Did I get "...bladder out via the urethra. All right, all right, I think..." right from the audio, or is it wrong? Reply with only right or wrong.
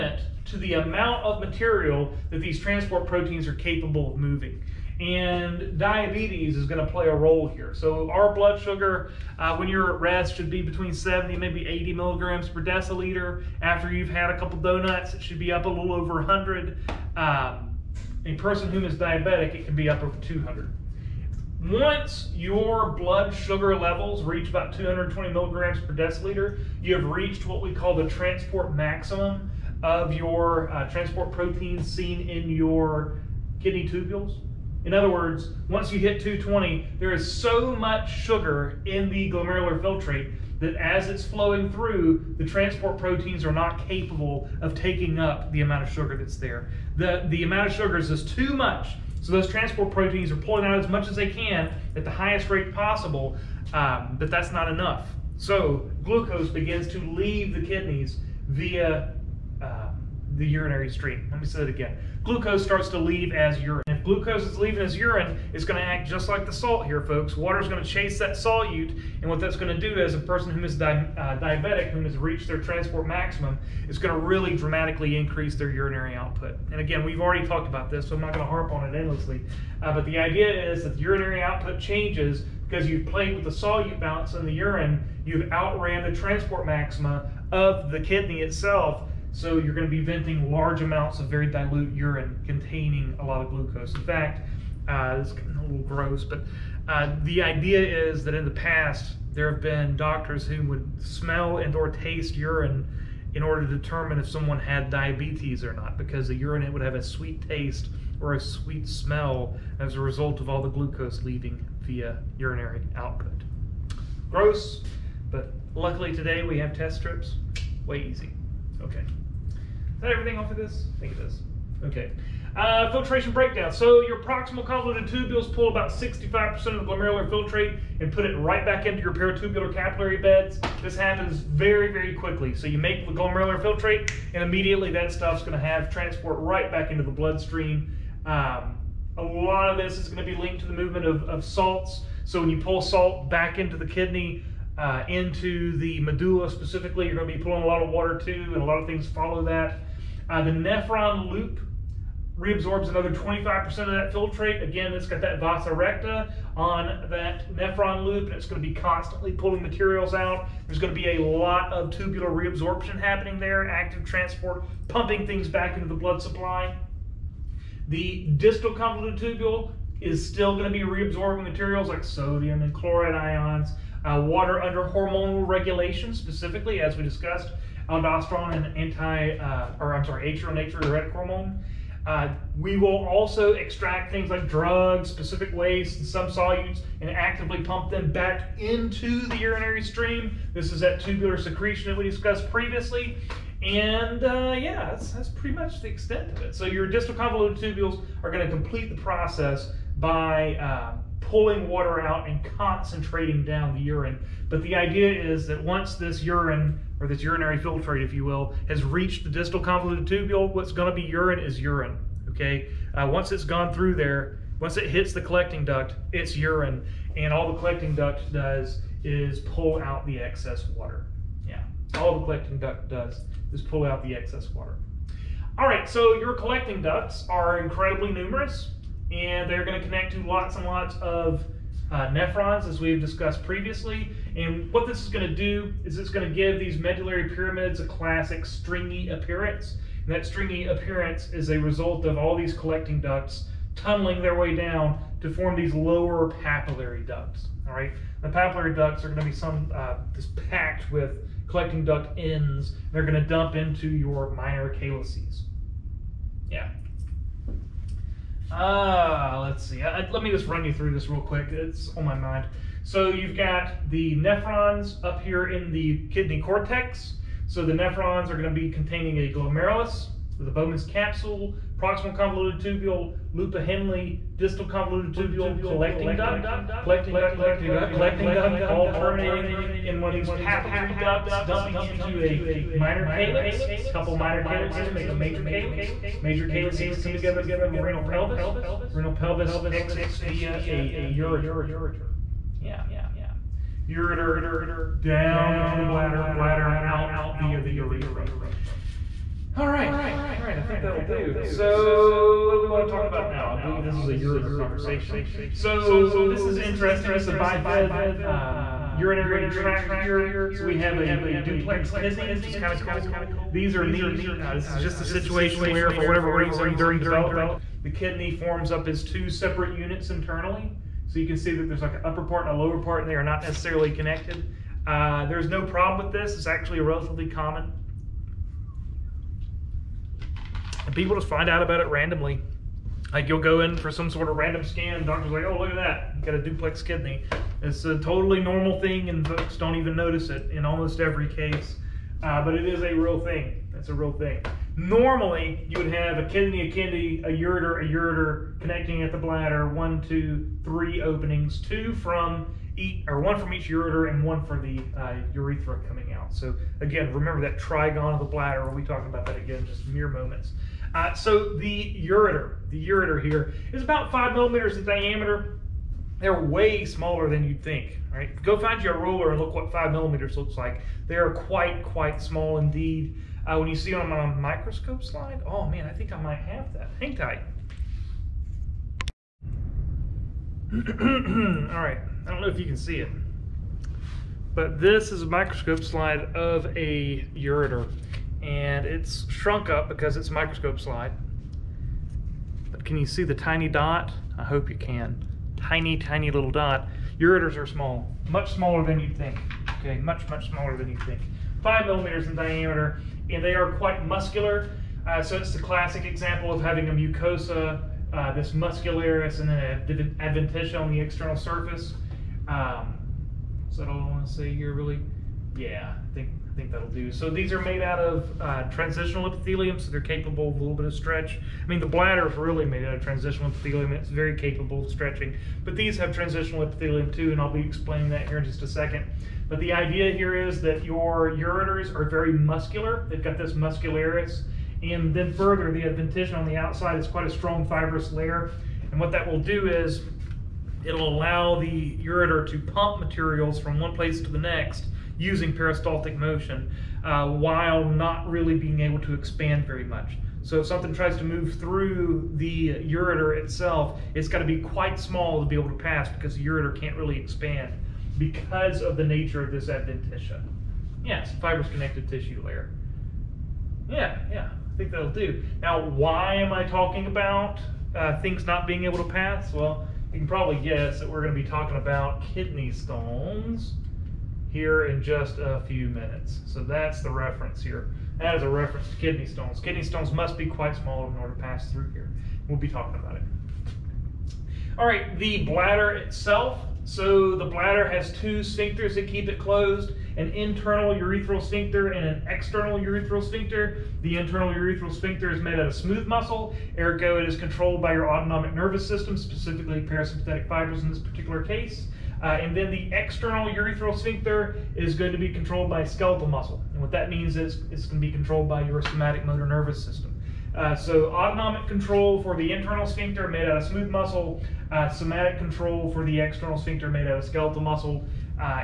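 right.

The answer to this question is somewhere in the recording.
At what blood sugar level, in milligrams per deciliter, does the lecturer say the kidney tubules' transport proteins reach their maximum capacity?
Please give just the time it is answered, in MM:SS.
00:24.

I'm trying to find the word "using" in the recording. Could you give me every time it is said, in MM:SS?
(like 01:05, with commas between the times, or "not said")
07:25.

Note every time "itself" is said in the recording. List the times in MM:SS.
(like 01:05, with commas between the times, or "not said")
01:28, 07:33, 08:05.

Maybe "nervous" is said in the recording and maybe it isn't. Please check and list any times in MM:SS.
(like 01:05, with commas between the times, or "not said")
08:18, 08:29.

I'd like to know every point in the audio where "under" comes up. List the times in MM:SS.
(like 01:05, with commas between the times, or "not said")
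02:54.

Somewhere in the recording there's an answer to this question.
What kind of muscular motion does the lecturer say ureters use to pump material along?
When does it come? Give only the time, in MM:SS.
07:25.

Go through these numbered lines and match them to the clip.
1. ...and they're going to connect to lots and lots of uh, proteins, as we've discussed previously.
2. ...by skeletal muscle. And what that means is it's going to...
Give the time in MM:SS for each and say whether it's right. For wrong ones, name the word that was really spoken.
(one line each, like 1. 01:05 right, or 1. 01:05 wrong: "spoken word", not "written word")
1. 03:49 wrong: "nephrons", not "proteins"
2. 08:25 right.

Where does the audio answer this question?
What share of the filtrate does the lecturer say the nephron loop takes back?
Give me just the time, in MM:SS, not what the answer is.
02:33.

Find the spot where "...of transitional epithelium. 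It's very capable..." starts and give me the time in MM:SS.
07:02.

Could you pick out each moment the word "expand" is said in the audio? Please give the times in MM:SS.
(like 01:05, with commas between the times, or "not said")
07:29, 07:37.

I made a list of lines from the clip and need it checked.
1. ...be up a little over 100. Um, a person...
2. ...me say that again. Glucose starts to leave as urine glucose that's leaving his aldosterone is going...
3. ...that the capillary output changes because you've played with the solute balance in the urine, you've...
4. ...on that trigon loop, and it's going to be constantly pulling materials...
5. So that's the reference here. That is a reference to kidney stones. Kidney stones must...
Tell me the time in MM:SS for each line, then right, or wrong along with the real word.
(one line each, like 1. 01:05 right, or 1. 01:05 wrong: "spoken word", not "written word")
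1. 00:15 right
2. 01:01 wrong: "urine", not "aldosterone"
3. 01:20 wrong: "urinary", not "capillary"
4. 02:36 wrong: "nephron", not "trigon"
5. 07:56 right.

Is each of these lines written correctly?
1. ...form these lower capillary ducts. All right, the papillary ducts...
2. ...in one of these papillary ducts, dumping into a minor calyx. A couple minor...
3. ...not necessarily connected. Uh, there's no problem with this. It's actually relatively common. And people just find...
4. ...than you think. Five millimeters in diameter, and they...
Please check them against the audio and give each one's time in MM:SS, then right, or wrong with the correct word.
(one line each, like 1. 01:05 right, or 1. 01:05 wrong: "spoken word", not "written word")
1. 04:05 wrong: "papillary", not "capillary"
2. 04:39 right
3. 05:23 right
4. 06:40 right.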